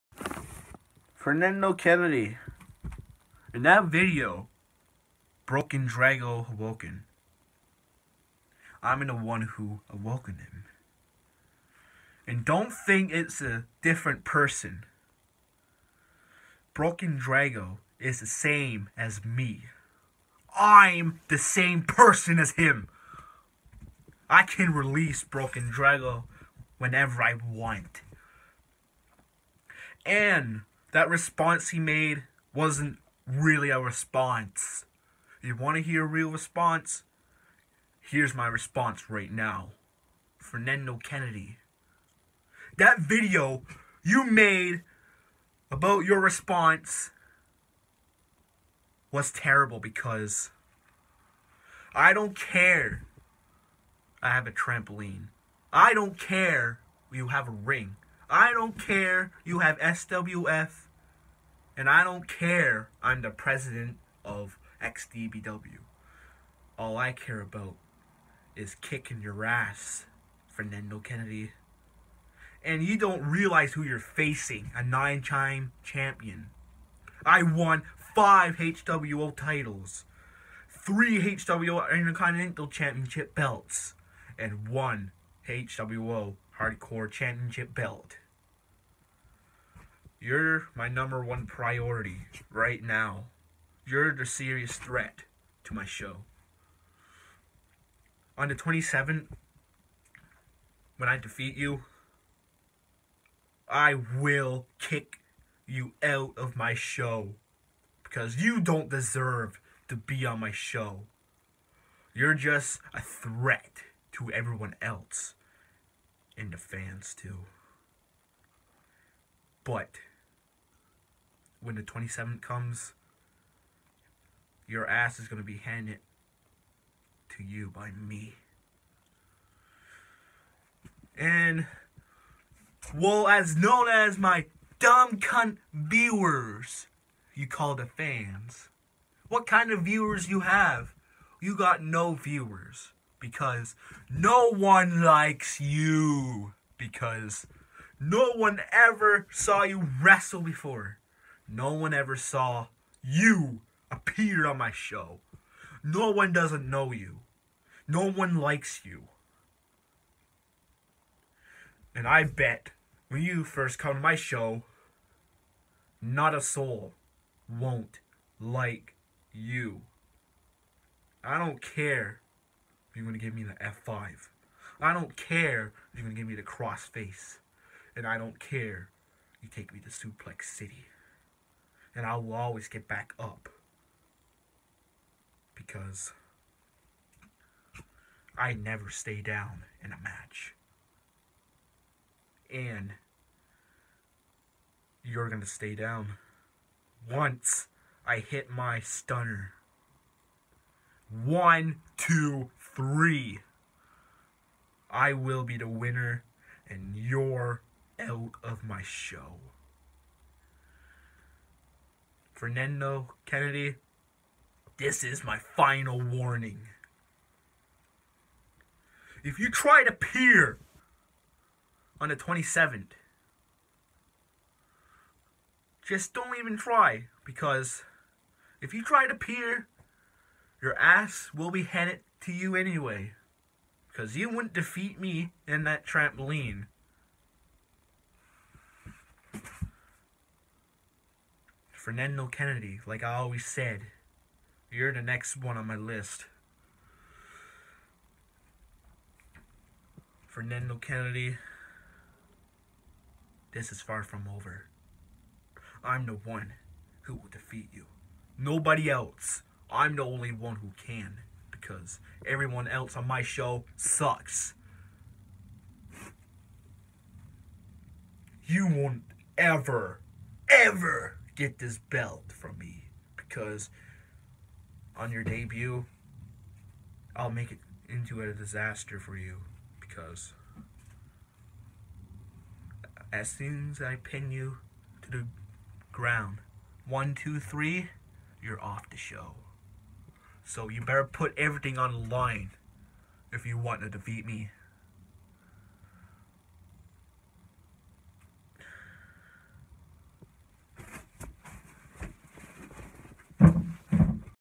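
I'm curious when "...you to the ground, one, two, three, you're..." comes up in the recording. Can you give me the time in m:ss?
4:44.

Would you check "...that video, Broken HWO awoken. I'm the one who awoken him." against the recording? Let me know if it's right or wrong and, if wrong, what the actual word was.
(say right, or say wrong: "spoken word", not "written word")
wrong: "Dragoh", not "HWO".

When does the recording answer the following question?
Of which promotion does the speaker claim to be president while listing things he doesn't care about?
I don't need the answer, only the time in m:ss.
1:04.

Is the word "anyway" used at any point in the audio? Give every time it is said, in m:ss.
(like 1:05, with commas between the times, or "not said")
3:52.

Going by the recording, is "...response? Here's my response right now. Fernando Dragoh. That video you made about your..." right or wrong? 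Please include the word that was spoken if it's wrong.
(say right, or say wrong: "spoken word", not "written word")
wrong: "Kennedy", not "Dragoh".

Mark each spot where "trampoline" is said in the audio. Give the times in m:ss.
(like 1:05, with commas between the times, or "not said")
0:54, 3:55.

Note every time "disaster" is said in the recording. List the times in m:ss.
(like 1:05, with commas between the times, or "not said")
4:38.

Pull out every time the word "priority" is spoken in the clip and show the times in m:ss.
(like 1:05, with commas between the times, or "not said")
1:31.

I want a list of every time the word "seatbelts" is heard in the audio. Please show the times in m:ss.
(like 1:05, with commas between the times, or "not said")
not said.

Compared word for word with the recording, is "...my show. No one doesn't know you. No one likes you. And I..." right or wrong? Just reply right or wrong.
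right.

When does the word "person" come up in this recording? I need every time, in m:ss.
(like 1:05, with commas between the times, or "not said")
0:14, 0:21.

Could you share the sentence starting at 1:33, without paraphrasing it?
You're the serious threat to my show.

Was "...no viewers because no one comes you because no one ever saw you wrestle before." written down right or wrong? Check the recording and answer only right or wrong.
wrong.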